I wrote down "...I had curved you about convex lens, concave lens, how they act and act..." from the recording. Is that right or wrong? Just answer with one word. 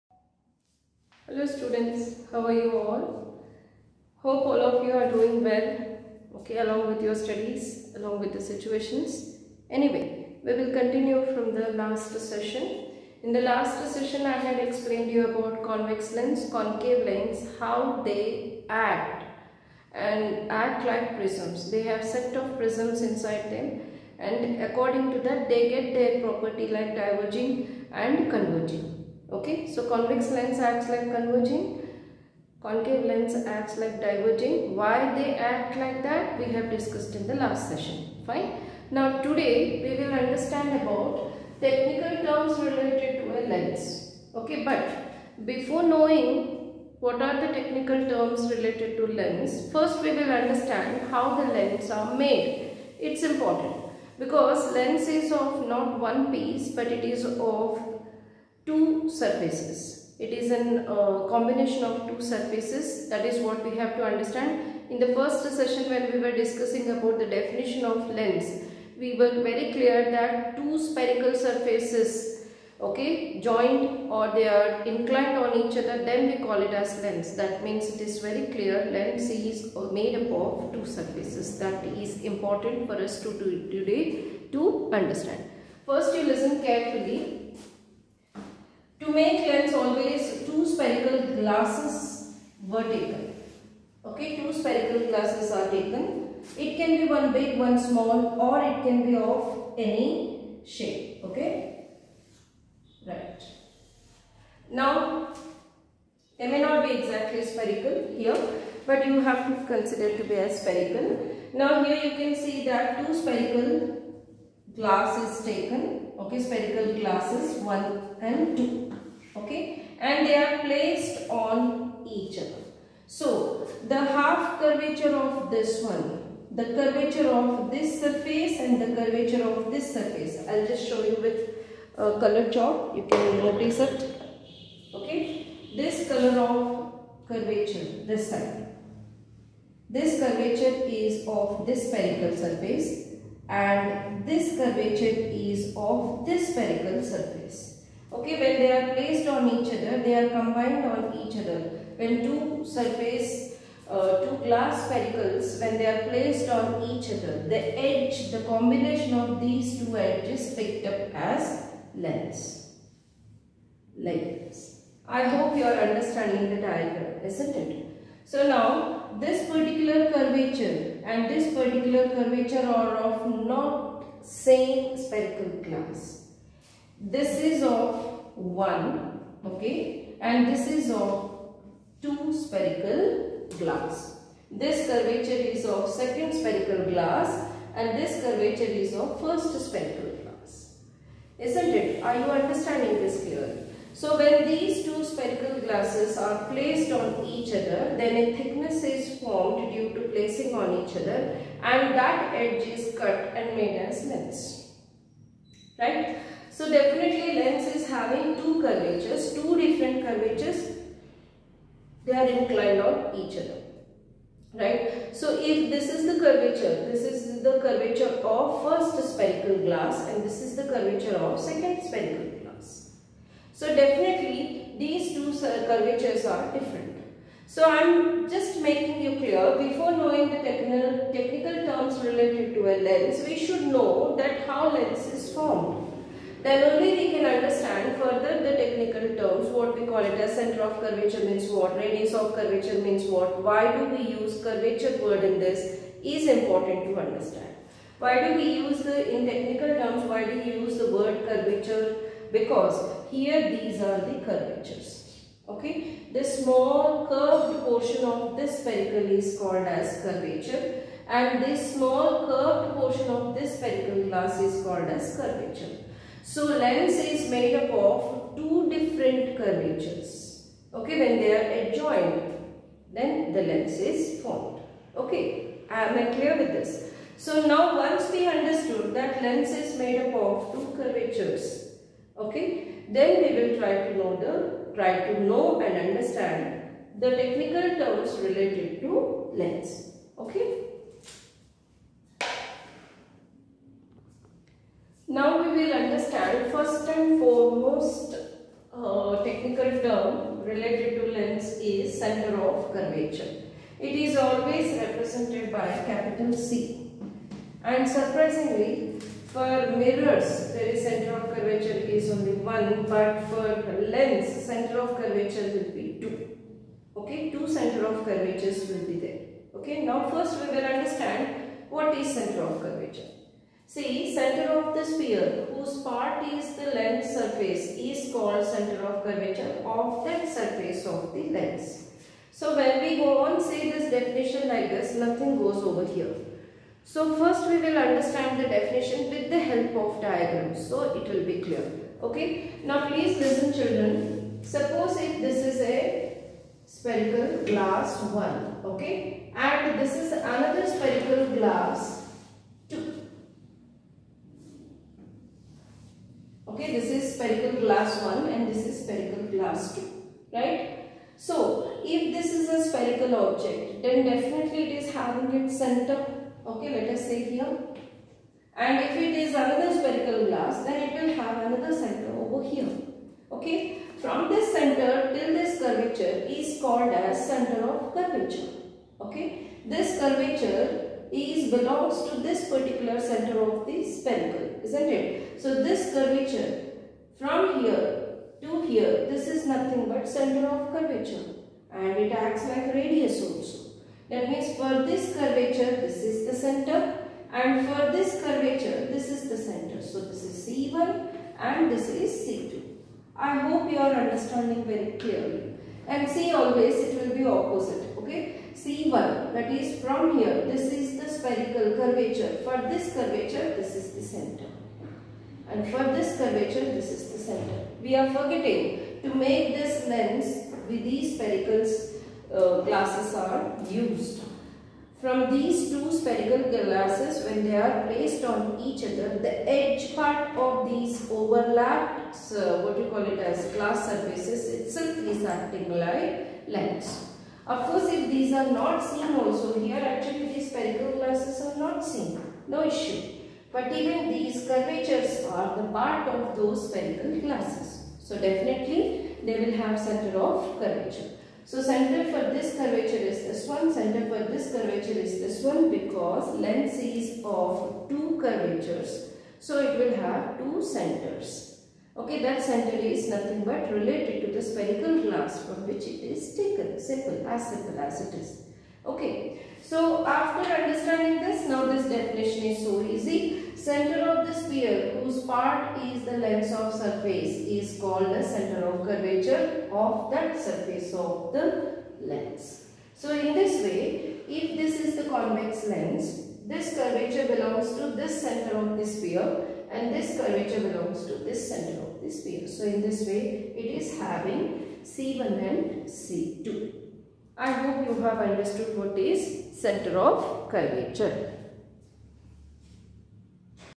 wrong.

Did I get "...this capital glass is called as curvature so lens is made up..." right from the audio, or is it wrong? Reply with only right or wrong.
wrong.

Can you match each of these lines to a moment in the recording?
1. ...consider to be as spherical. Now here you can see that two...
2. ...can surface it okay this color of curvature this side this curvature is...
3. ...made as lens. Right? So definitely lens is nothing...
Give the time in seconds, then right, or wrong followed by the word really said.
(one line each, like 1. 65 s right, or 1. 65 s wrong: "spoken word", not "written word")
1. 109 s right
2. 133 s wrong: "notice", not "surface"
3. 203 s wrong: "having", not "nothing".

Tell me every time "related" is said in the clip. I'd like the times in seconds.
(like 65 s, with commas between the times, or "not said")
42 s, 48 s, 232 s, 288 s, 300 s, 463 s.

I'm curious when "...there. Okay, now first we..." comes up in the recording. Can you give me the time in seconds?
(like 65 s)
318 s.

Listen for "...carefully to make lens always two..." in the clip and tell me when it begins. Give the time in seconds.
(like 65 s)
86 s.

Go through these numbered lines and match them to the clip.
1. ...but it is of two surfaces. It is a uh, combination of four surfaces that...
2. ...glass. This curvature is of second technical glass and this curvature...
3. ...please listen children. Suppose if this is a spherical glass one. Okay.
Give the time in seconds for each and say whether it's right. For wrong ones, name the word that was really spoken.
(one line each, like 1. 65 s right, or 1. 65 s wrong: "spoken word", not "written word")
1. 56 s wrong: "two", not "four"
2. 183 s wrong: "spherical", not "technical"
3. 342 s right.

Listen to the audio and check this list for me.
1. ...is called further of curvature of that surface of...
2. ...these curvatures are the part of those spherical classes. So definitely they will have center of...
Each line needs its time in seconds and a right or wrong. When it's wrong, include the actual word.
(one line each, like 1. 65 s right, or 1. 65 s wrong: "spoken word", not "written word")
1. 327 s wrong: "center", not "further"
2. 444 s right.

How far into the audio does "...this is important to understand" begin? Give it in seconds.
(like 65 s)
245 s.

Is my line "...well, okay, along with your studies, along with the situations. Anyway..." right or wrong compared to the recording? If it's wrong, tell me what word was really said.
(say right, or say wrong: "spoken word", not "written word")
right.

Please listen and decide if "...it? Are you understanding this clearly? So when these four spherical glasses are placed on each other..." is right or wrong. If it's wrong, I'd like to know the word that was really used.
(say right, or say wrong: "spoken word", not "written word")
wrong: "two", not "four".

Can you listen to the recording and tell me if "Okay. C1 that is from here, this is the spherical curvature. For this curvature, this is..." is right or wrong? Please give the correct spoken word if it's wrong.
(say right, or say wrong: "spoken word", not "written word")
right.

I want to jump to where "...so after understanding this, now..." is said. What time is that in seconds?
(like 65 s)
469 s.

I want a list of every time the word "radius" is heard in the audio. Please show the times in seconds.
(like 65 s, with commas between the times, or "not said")
241 s, 392 s.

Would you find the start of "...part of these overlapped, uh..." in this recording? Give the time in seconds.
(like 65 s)
429 s.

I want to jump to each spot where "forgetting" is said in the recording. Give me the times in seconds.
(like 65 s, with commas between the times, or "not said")
418 s.